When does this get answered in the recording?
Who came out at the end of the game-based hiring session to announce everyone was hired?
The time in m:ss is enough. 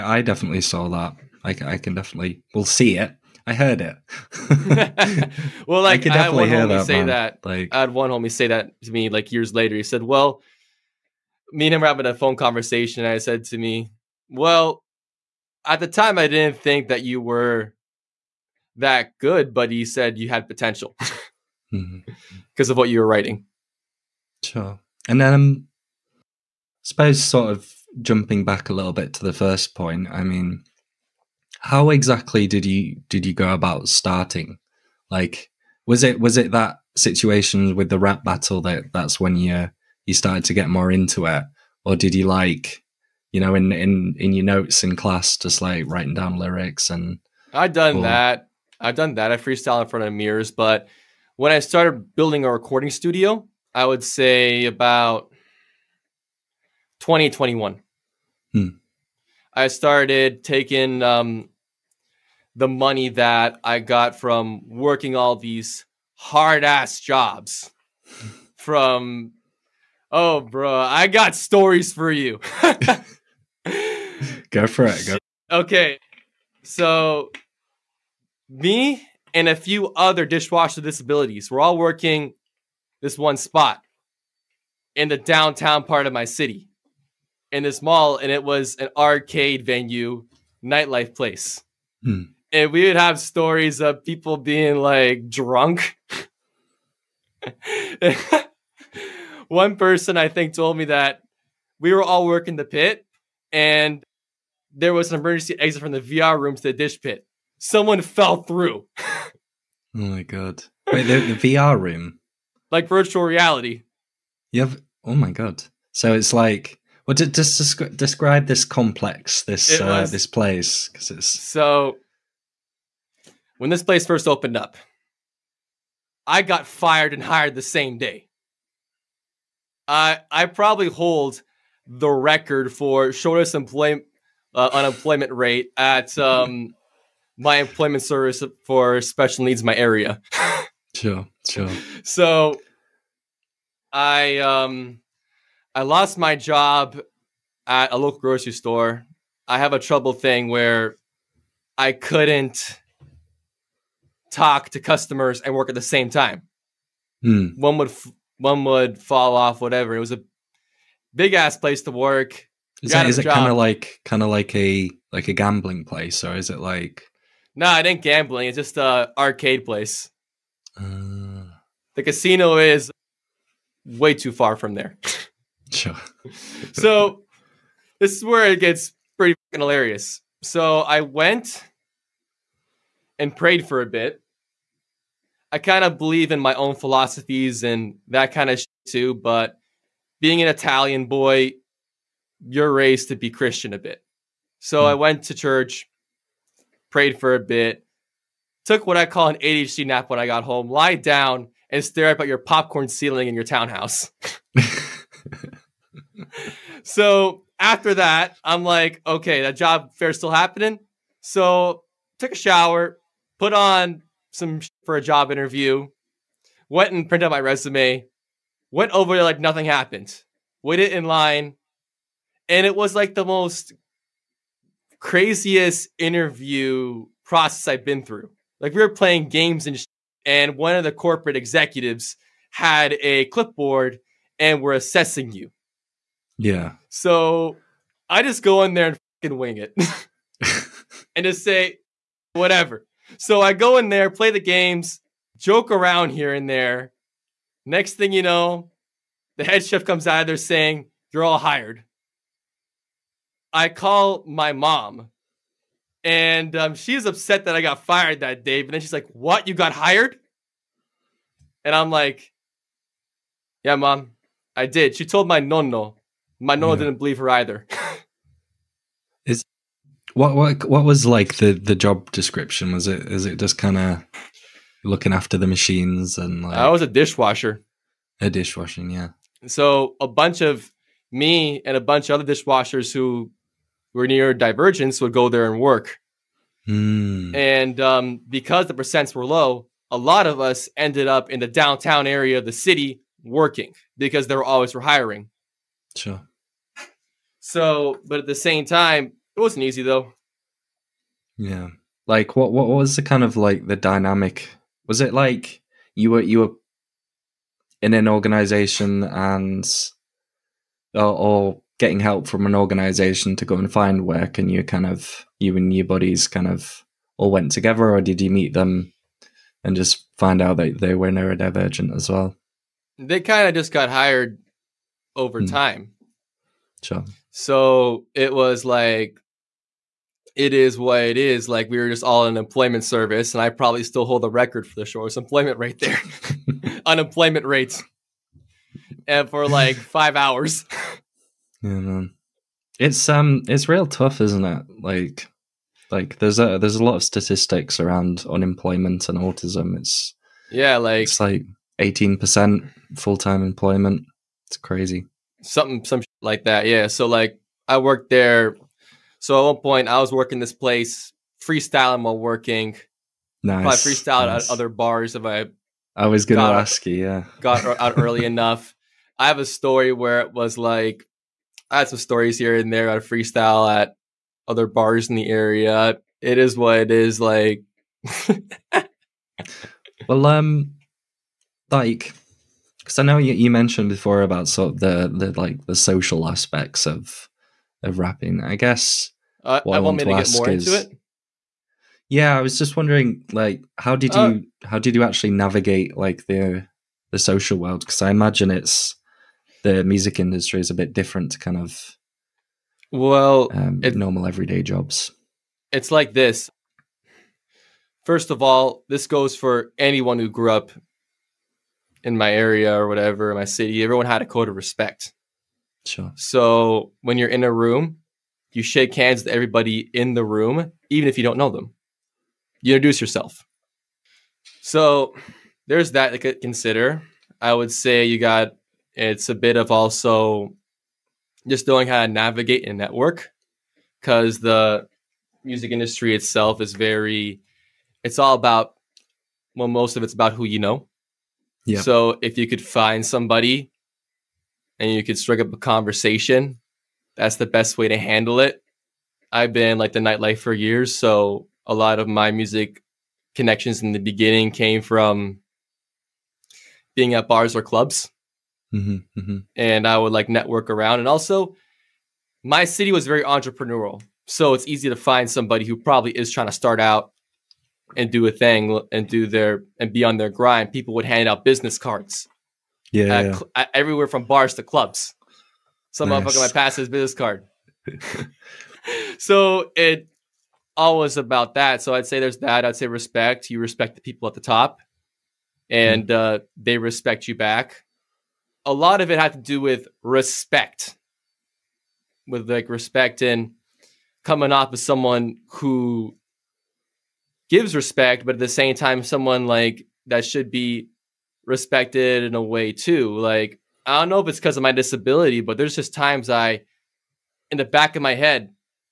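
4:09.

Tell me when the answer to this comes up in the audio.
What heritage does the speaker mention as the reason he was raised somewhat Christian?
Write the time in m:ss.
3:10.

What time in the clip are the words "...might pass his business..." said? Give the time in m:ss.
7:56.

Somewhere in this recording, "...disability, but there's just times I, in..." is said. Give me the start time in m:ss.
8:24.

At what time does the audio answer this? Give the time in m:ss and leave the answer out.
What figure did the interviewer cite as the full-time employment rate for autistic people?
5:51.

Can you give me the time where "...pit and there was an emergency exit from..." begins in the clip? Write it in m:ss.
1:42.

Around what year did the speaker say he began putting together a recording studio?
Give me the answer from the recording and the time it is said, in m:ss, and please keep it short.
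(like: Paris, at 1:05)
2021, at 0:56.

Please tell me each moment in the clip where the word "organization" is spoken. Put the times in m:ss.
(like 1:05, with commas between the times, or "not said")
5:08, 5:12.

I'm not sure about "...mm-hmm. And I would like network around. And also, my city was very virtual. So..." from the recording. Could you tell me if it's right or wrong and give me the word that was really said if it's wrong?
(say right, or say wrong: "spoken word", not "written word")
wrong: "entrepreneurial", not "virtual".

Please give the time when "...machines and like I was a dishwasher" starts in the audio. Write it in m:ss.
4:35.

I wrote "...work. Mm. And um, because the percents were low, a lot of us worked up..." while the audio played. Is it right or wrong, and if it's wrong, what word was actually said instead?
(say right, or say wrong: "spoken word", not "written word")
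wrong: "ended", not "worked".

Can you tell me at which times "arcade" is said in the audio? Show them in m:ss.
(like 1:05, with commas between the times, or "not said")
1:28, 2:49.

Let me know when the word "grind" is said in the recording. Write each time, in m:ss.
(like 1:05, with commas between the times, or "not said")
7:50.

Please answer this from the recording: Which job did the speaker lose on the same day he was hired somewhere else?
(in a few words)
Local grocery store.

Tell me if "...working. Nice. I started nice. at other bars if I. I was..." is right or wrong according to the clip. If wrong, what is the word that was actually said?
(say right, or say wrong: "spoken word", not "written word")
wrong: "freestyled", not "started".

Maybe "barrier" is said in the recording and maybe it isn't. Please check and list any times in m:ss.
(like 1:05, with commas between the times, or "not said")
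not said.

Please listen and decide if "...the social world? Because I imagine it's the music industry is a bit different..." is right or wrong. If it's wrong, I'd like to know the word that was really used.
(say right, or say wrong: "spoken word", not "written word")
right.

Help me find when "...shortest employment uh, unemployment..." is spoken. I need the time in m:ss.
2:13.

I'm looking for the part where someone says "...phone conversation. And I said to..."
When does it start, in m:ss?
0:12.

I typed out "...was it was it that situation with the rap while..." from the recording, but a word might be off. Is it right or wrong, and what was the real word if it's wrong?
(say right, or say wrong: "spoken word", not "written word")
wrong: "battle", not "while".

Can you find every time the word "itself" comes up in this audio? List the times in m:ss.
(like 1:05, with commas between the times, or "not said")
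7:16.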